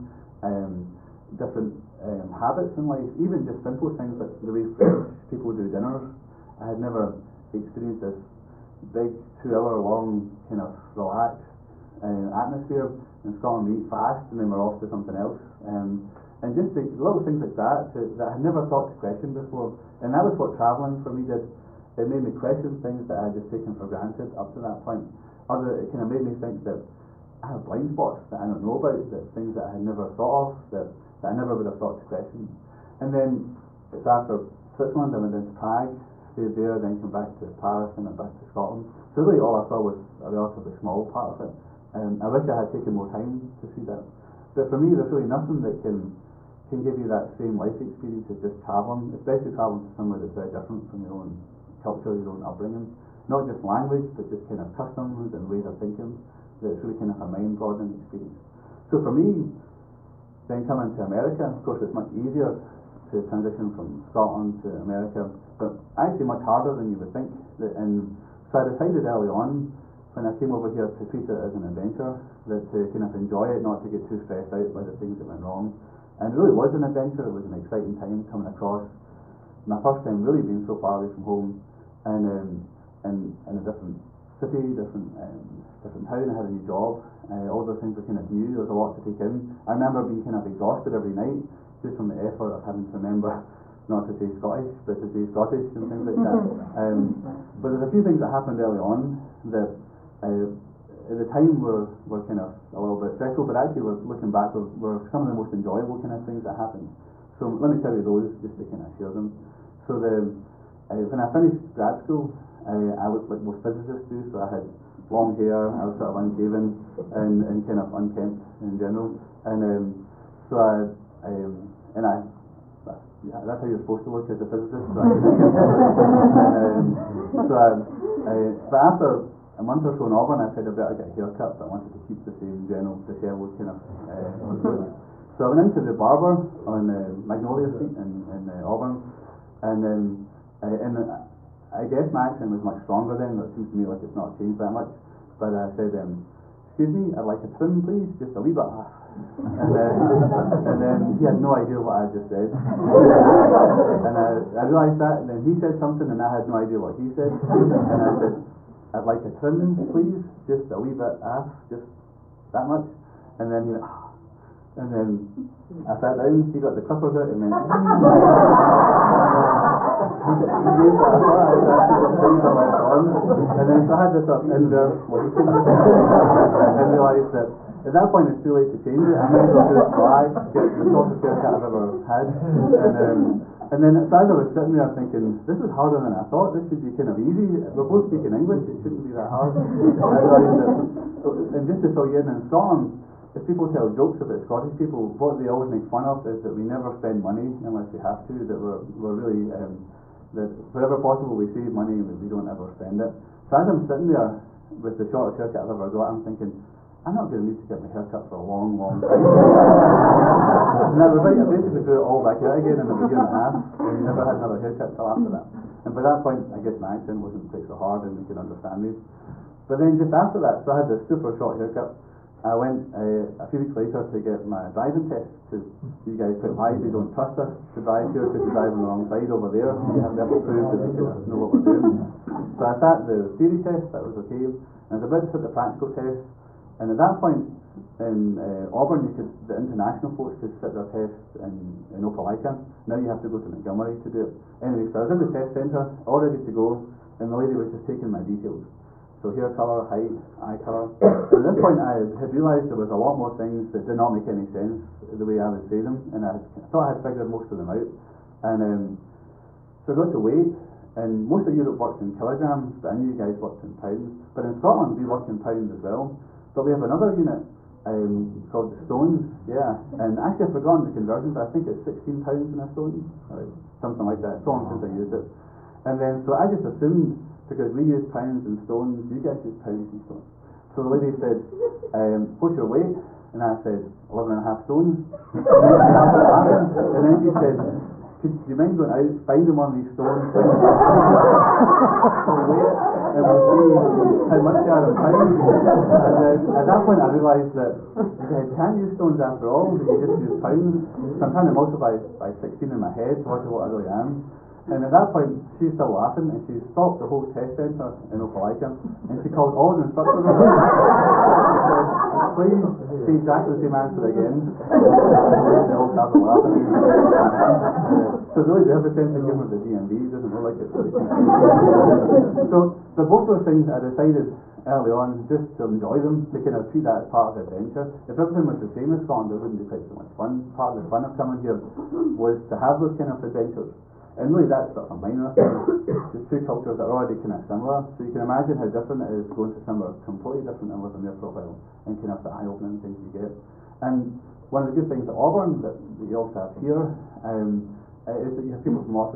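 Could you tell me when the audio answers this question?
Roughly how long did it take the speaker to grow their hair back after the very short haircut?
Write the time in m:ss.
3:33.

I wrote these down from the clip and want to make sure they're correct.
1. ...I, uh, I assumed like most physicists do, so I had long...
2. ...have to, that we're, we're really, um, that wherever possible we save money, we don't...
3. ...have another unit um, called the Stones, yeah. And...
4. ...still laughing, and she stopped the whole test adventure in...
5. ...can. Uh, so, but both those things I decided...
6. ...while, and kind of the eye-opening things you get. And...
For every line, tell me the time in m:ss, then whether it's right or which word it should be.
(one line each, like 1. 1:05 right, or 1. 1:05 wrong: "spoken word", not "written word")
1. 1:52 wrong: "looked", not "assumed"
2. 3:17 right
3. 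4:26 right
4. 5:05 wrong: "centre", not "adventure"
5. 5:20 right
6. 5:41 right.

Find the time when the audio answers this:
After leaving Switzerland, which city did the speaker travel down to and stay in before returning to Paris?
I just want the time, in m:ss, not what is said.
0:35.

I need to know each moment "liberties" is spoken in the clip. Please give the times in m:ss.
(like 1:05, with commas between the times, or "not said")
not said.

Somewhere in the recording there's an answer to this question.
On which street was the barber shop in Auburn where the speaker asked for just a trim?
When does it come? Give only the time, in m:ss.
2:17.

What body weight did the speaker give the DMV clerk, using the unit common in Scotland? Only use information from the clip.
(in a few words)
11 and a half stones.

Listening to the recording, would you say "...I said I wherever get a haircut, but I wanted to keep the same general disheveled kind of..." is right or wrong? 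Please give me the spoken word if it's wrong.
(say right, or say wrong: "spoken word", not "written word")
wrong: "better", not "wherever".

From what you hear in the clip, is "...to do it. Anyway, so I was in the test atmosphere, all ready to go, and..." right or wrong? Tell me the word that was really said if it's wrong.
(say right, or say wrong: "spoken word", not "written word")
wrong: "centre", not "atmosphere".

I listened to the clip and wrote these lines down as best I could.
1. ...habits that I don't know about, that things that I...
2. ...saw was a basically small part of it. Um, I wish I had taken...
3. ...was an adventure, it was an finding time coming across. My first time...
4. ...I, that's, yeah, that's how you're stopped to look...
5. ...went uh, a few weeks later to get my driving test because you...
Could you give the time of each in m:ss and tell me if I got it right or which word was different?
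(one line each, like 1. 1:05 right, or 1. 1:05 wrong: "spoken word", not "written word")
1. 0:27 wrong: "spots", not "habits"
2. 0:39 wrong: "relatively", not "basically"
3. 1:16 wrong: "exciting", not "finding"
4. 2:02 wrong: "supposed", not "stopped"
5. 3:42 right.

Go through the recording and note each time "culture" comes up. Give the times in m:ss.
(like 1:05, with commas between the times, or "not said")
0:51, 5:36.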